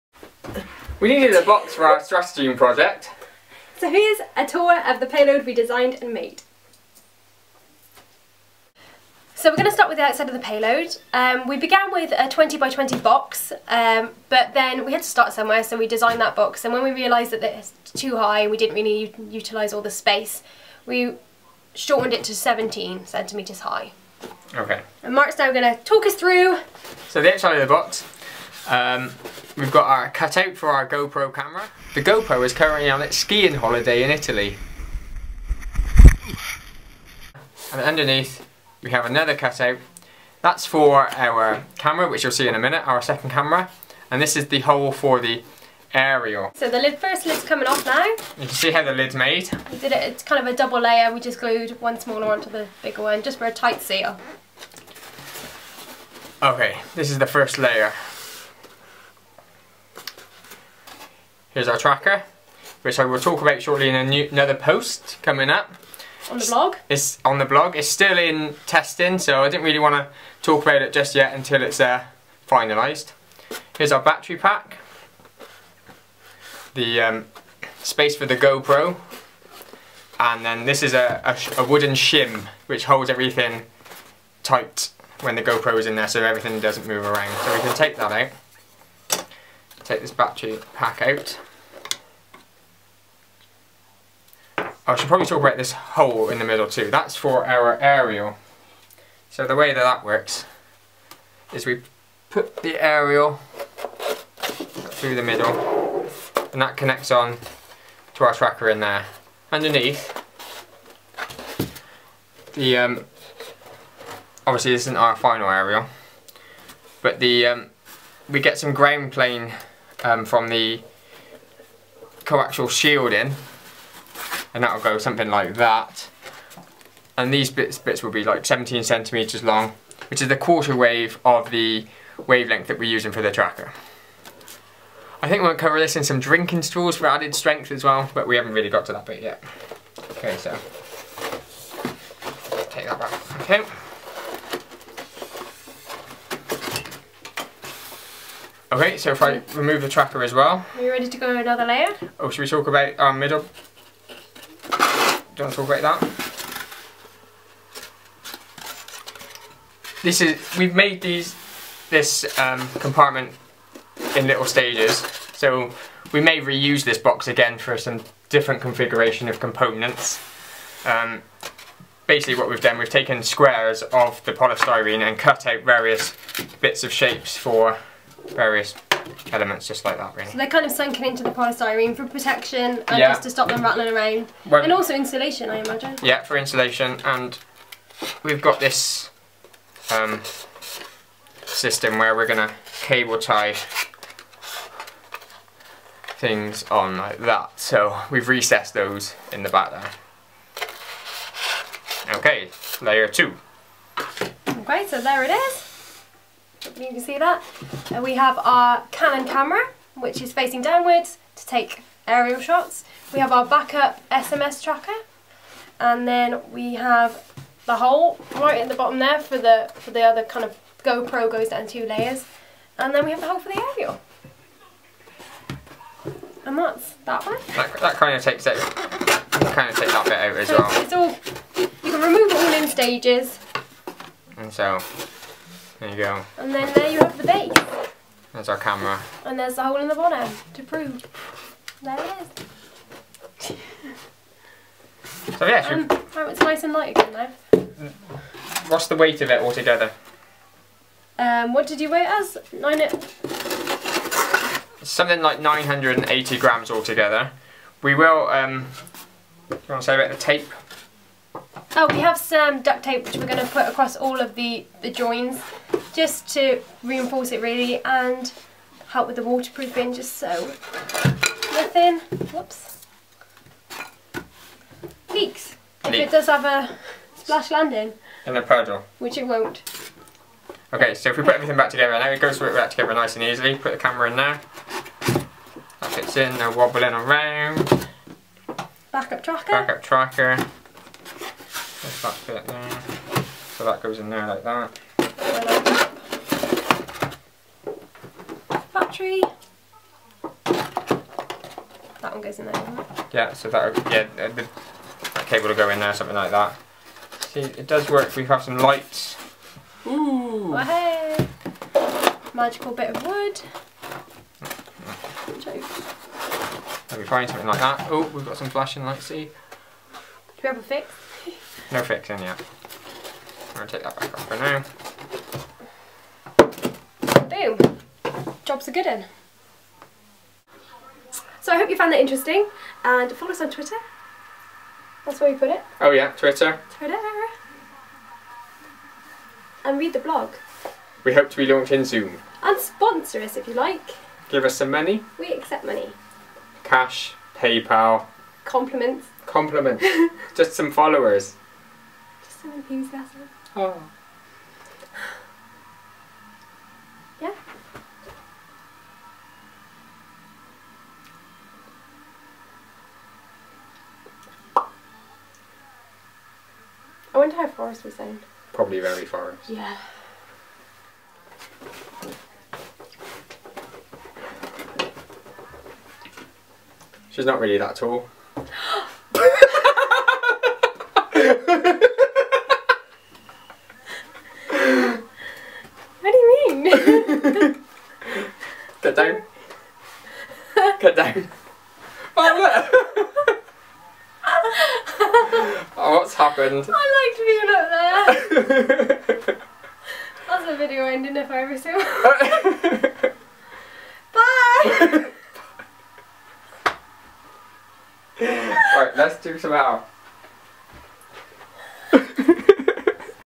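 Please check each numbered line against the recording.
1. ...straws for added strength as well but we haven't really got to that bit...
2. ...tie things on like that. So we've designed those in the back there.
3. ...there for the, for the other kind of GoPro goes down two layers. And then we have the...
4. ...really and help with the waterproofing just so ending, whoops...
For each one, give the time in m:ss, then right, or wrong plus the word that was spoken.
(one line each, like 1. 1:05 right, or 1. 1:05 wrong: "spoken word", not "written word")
1. 2:16 right
2. 3:13 wrong: "recessed", not "designed"
3. 3:38 right
4. 4:27 wrong: "nothing", not "ending".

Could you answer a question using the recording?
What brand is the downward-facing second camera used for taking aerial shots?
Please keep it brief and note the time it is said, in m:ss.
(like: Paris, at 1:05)
Canon, at 3:28.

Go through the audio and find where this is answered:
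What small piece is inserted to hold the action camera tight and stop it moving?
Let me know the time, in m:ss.
1:21.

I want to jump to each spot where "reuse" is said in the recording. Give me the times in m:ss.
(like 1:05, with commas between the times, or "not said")
2:46.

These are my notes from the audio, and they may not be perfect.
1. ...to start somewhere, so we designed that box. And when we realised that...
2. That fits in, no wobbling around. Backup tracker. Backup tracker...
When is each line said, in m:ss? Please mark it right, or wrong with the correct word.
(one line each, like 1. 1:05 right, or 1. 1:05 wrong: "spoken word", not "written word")
1. 0:15 right
2. 4:45 right.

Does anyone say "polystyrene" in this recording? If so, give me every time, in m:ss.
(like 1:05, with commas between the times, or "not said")
2:54, 3:01.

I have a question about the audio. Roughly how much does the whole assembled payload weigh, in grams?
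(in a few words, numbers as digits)
980 grams.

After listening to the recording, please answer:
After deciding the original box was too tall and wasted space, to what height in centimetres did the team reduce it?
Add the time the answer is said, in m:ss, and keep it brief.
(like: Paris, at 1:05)
17 centimetres, at 0:22.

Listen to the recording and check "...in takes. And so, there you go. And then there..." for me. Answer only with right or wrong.
wrong.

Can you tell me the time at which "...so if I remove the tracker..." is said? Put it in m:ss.
2:28.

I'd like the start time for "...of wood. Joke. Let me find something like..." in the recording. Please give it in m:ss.
5:12.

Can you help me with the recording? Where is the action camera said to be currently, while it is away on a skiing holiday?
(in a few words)
Italy.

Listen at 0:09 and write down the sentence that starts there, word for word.
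So we're going to start with the outside of the payload.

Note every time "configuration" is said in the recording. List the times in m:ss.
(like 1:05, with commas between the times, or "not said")
2:48.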